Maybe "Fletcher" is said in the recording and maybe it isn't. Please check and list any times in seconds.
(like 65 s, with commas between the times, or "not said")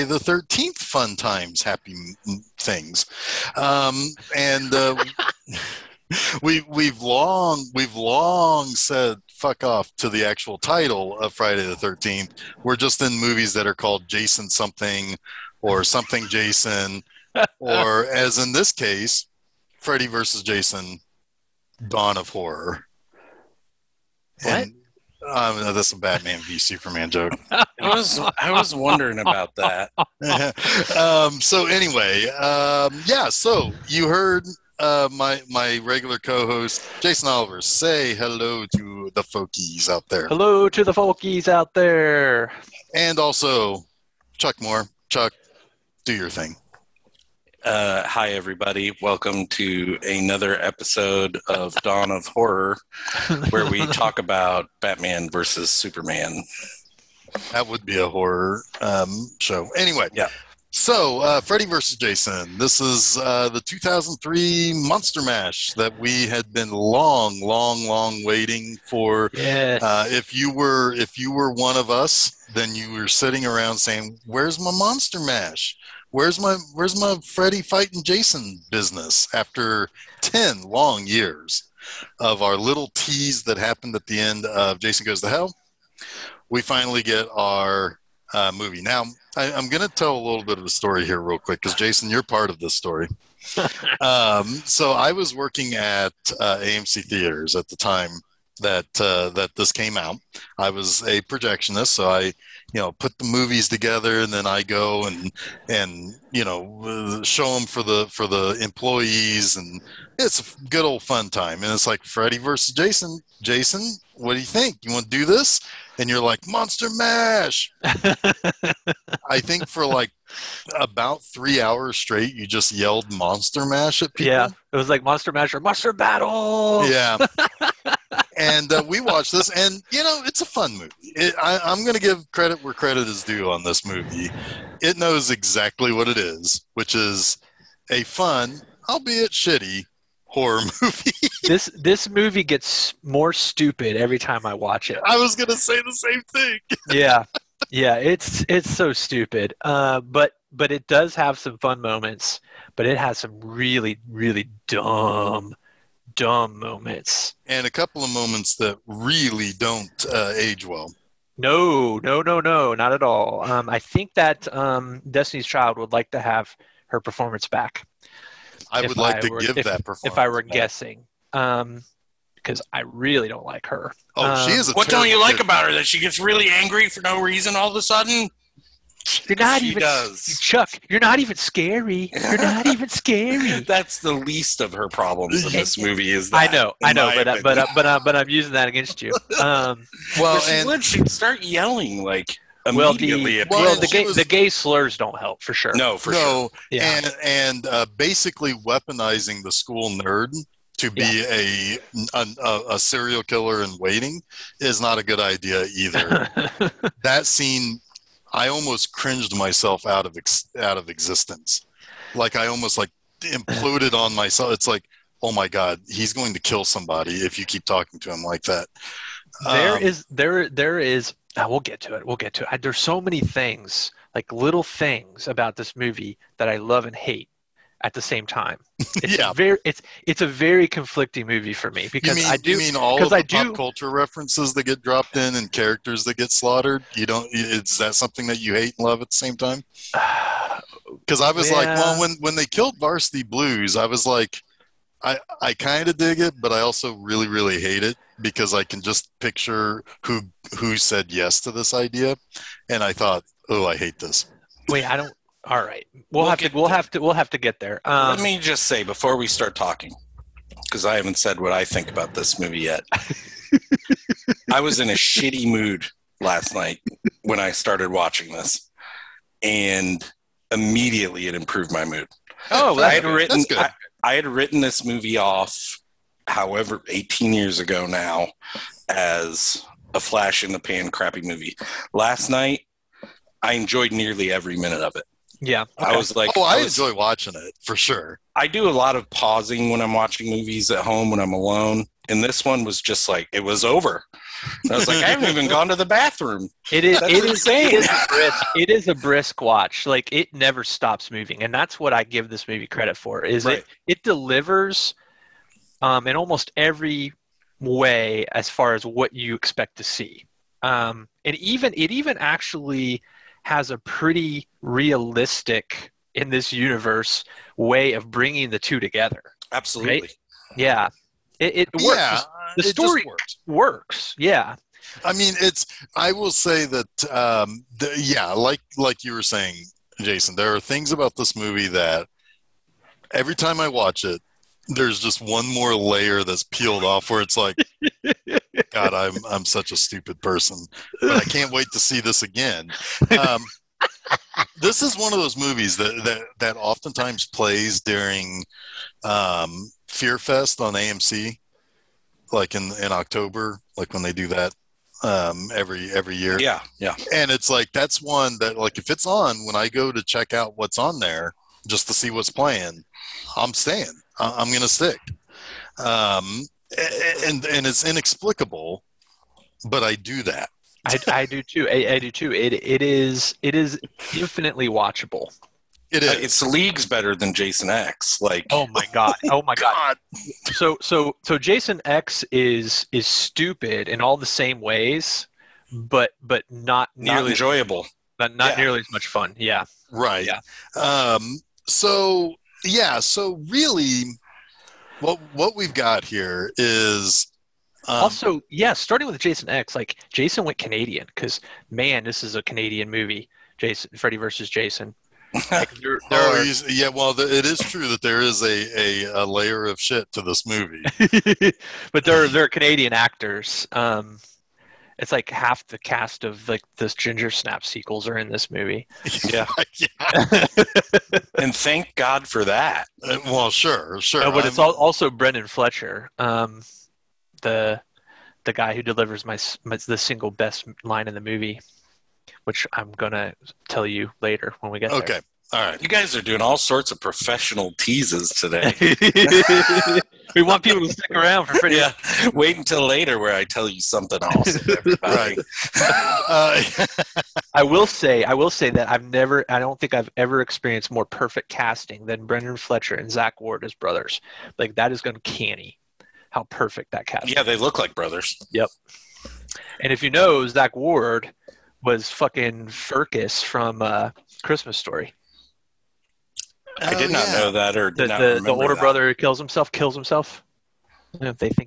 425 s, 452 s.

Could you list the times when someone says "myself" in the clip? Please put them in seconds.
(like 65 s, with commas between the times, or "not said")
209 s, 214 s.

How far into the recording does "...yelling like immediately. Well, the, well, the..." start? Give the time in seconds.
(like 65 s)
191 s.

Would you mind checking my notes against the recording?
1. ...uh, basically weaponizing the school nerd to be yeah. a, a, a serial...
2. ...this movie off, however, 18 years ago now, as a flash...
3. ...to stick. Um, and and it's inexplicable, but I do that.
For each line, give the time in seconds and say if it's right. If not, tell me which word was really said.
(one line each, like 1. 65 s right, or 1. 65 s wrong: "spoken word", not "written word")
1. 197 s right
2. 274 s right
3. 364 s right.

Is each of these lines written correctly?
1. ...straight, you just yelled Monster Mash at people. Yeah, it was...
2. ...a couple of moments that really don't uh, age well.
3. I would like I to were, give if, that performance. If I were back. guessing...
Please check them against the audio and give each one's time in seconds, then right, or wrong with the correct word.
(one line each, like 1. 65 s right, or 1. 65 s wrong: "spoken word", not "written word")
1. 121 s right
2. 157 s right
3. 168 s right.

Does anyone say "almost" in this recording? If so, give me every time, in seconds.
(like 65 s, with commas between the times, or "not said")
208 s, 212 s, 306 s.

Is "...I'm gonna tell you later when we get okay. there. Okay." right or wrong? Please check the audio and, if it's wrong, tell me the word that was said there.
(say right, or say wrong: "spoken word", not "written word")
right.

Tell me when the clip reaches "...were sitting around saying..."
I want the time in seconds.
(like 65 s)
72 s.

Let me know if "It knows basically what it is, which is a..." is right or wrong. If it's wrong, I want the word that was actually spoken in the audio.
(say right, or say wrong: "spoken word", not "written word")
wrong: "exactly", not "basically".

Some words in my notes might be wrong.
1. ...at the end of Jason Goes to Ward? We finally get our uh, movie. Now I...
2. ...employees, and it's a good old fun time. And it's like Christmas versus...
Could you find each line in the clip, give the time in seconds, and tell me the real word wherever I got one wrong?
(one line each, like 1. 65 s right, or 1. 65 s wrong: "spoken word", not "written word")
1. 83 s wrong: "Hell", not "Ward"
2. 108 s wrong: "Freddy", not "Christmas".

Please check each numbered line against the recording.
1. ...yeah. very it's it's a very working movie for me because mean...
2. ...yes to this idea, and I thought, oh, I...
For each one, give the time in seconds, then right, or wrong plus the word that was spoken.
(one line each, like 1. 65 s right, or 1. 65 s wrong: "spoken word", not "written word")
1. 229 s wrong: "conflicting", not "working"
2. 251 s right.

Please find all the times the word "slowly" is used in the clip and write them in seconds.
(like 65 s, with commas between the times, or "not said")
not said.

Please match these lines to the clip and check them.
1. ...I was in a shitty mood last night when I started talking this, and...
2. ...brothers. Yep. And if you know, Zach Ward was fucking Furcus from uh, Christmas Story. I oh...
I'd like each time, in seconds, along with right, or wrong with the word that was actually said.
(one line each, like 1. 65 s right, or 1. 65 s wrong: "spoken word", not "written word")
1. 264 s wrong: "watching", not "talking"
2. 457 s right.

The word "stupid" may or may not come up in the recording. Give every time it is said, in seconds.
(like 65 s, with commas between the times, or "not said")
143 s, 148 s, 339 s, 383 s.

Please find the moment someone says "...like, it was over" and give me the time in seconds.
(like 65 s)
293 s.